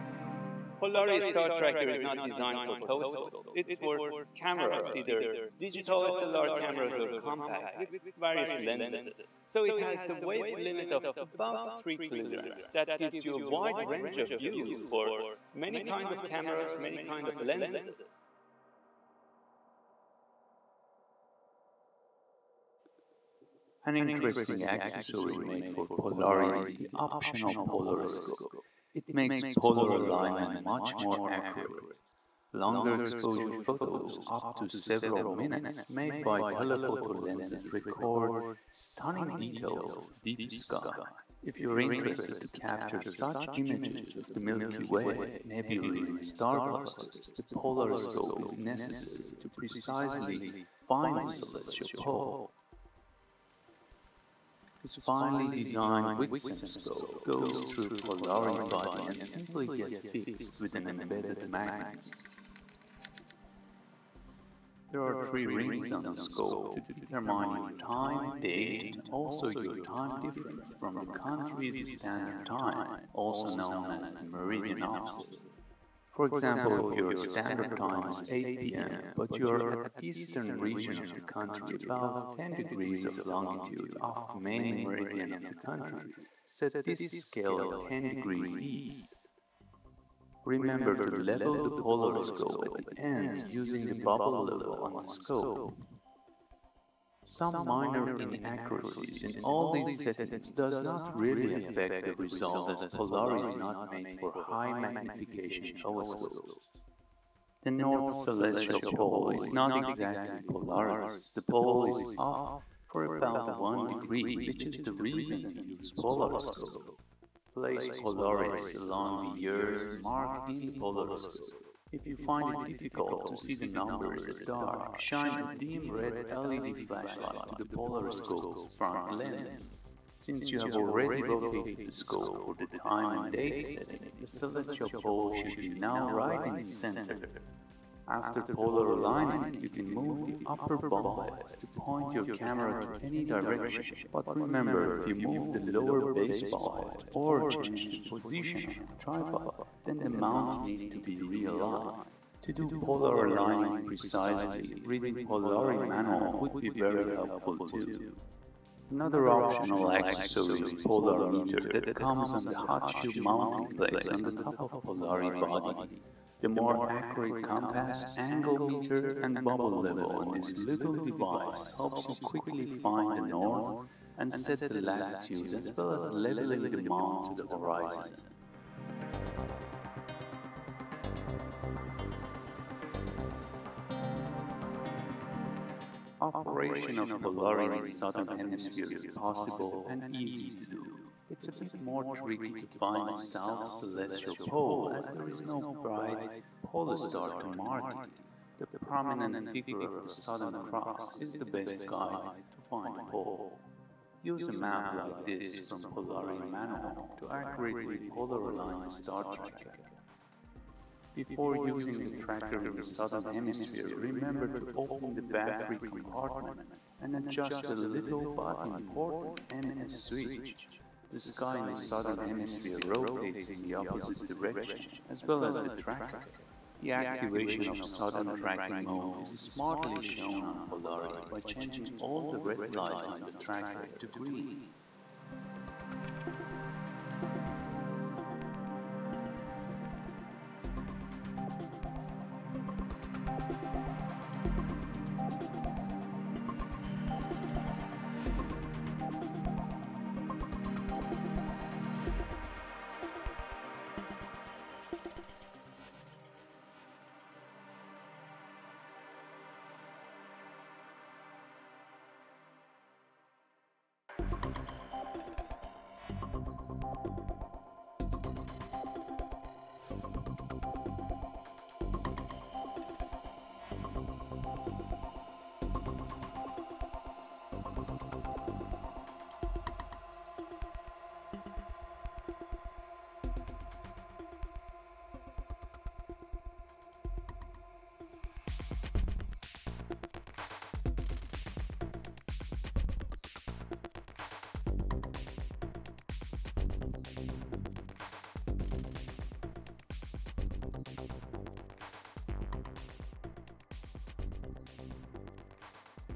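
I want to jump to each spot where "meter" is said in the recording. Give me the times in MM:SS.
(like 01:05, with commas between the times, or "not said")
02:41, 02:48.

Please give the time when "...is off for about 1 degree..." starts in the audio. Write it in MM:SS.
01:51.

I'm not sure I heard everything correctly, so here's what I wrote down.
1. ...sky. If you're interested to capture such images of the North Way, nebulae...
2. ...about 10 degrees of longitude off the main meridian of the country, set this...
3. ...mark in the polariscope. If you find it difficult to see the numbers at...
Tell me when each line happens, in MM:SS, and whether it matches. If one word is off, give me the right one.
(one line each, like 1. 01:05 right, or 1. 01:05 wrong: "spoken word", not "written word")
1. 00:40 wrong: "Milky", not "North"
2. 01:21 right
3. 01:59 right.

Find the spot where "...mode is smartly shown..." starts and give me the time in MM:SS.
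03:48.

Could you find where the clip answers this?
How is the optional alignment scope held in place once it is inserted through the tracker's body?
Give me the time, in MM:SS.
01:01.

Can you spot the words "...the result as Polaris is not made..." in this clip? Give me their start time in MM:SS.
01:42.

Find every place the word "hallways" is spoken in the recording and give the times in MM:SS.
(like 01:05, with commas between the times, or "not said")
not said.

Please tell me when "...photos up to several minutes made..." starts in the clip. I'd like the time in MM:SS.
00:33.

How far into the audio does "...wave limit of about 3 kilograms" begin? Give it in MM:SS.
00:10.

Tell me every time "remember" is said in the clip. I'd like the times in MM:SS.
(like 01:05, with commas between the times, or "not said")
01:30, 02:24, 03:33.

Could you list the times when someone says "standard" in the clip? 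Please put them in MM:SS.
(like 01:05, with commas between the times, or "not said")
01:11, 01:17.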